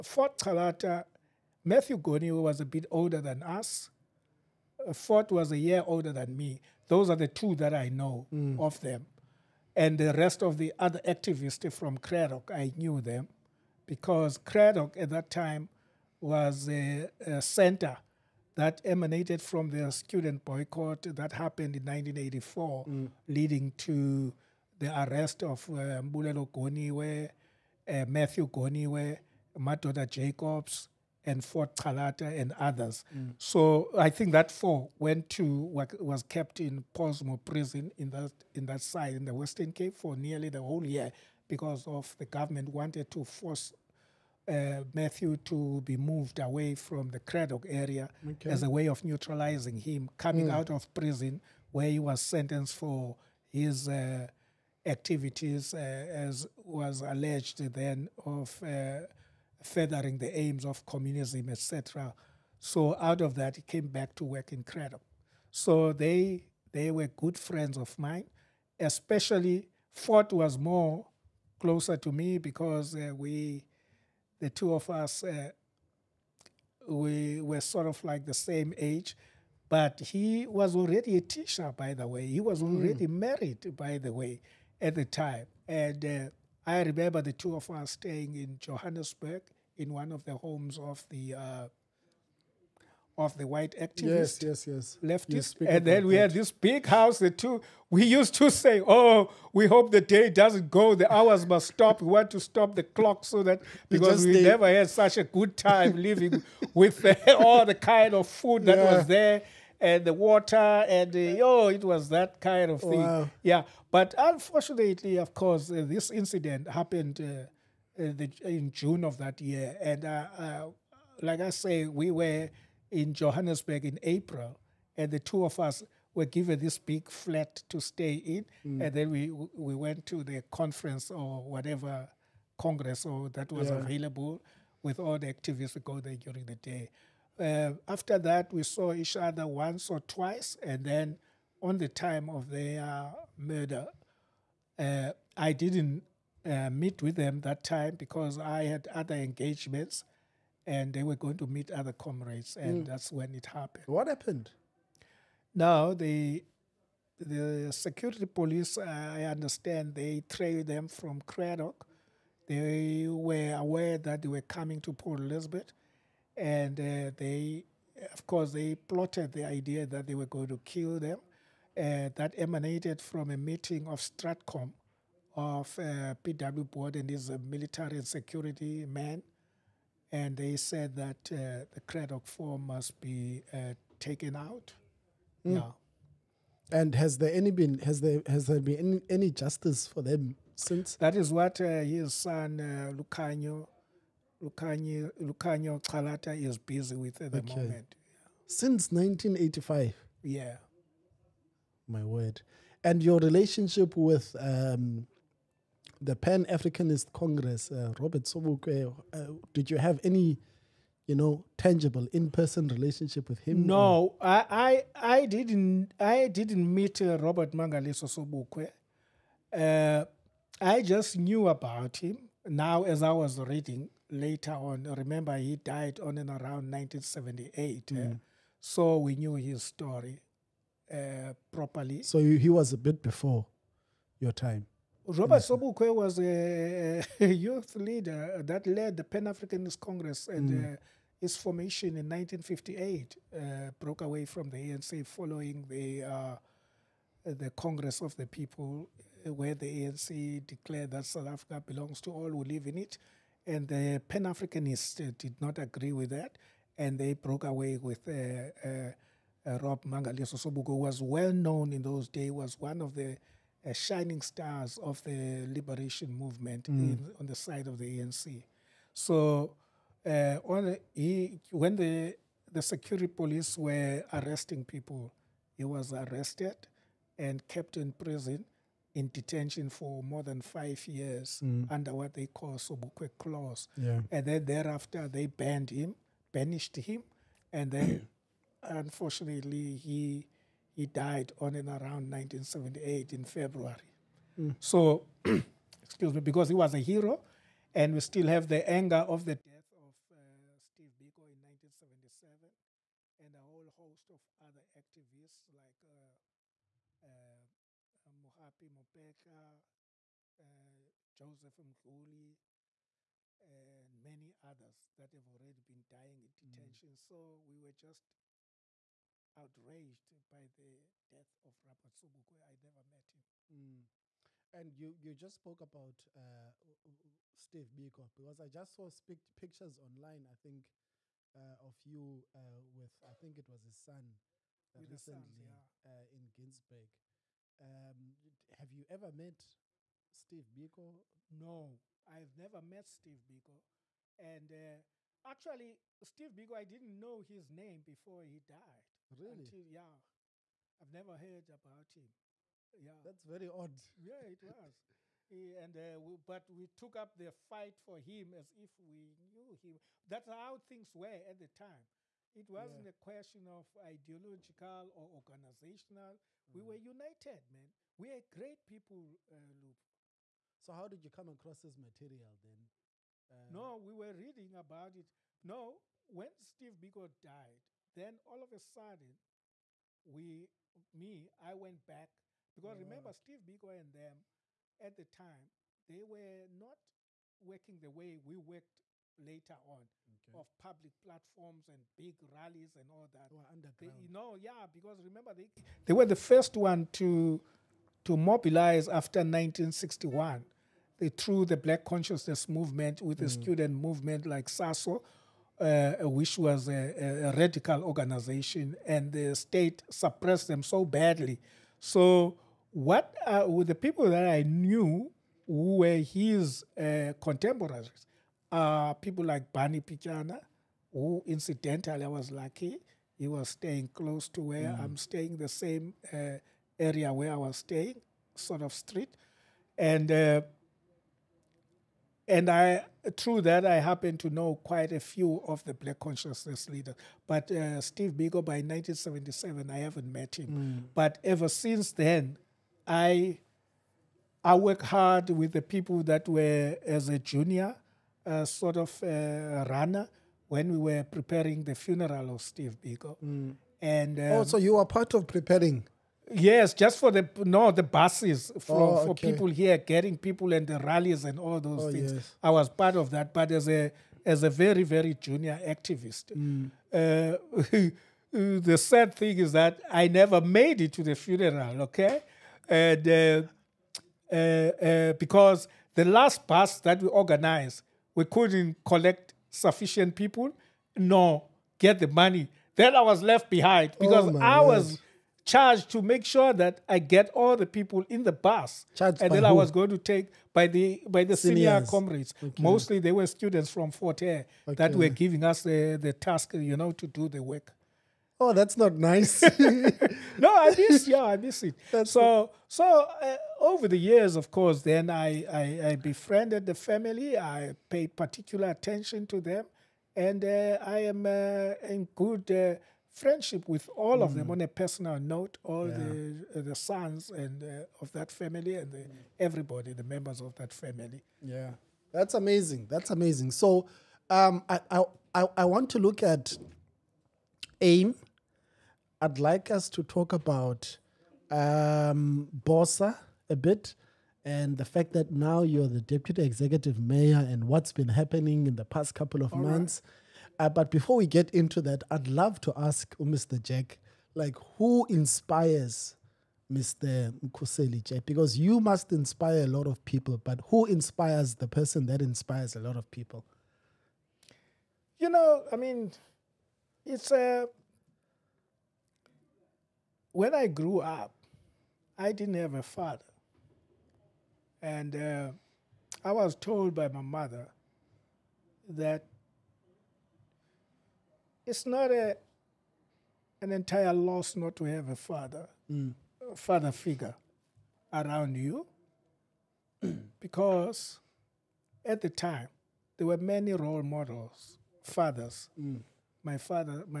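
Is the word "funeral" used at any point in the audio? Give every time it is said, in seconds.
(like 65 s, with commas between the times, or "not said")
451 s, 471 s.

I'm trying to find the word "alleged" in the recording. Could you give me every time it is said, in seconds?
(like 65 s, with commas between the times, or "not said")
57 s.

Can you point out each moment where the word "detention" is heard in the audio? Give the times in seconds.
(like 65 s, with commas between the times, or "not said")
279 s, 316 s.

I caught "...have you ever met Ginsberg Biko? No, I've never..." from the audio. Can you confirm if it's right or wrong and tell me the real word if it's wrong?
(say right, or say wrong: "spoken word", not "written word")
wrong: "Steve", not "Ginsberg".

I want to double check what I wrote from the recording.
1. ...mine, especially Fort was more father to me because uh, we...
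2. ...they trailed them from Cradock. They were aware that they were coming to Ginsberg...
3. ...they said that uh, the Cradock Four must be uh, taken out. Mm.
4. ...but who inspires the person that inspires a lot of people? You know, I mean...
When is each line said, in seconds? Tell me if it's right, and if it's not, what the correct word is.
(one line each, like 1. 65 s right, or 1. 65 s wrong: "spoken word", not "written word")
1. 67 s wrong: "closer", not "father"
2. 159 s wrong: "Port", not "Ginsberg"
3. 180 s right
4. 550 s right.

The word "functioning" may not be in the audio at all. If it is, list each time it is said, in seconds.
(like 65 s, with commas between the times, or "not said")
not said.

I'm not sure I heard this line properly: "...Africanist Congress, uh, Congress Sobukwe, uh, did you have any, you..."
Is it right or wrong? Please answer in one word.
wrong.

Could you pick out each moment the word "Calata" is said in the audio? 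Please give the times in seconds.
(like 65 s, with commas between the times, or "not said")
0 s, 31 s, 195 s.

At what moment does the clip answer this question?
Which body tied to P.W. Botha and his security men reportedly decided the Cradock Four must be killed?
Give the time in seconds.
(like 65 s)
173 s.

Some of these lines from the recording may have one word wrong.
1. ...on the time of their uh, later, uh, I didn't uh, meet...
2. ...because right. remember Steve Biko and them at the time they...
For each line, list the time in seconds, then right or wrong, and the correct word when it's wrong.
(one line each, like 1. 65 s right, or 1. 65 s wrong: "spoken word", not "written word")
1. 141 s wrong: "murder", not "later"
2. 382 s right.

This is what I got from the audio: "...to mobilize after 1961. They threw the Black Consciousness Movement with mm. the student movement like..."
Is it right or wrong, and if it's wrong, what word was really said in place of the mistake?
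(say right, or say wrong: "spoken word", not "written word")
right.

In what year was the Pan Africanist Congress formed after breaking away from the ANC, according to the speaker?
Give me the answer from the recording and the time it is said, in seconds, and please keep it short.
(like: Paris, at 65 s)
1958, at 242 s.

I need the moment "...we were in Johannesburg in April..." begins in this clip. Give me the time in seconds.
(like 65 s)
121 s.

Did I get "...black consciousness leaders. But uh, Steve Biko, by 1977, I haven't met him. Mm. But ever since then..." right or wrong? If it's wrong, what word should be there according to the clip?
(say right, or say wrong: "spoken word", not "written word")
right.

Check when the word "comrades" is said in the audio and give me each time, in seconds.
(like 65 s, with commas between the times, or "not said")
151 s, 491 s.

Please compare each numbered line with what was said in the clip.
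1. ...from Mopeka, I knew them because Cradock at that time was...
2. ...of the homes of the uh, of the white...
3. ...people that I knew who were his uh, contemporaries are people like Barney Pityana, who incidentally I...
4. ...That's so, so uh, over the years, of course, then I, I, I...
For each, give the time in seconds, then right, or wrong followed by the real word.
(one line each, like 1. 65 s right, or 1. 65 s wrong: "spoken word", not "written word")
1. 11 s wrong: "Cradock", not "Mopeka"
2. 90 s right
3. 413 s right
4. 501 s right.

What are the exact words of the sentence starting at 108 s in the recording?
was there and the water and uh, oh, it was that kind of thing.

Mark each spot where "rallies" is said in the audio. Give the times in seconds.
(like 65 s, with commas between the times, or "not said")
392 s, 460 s.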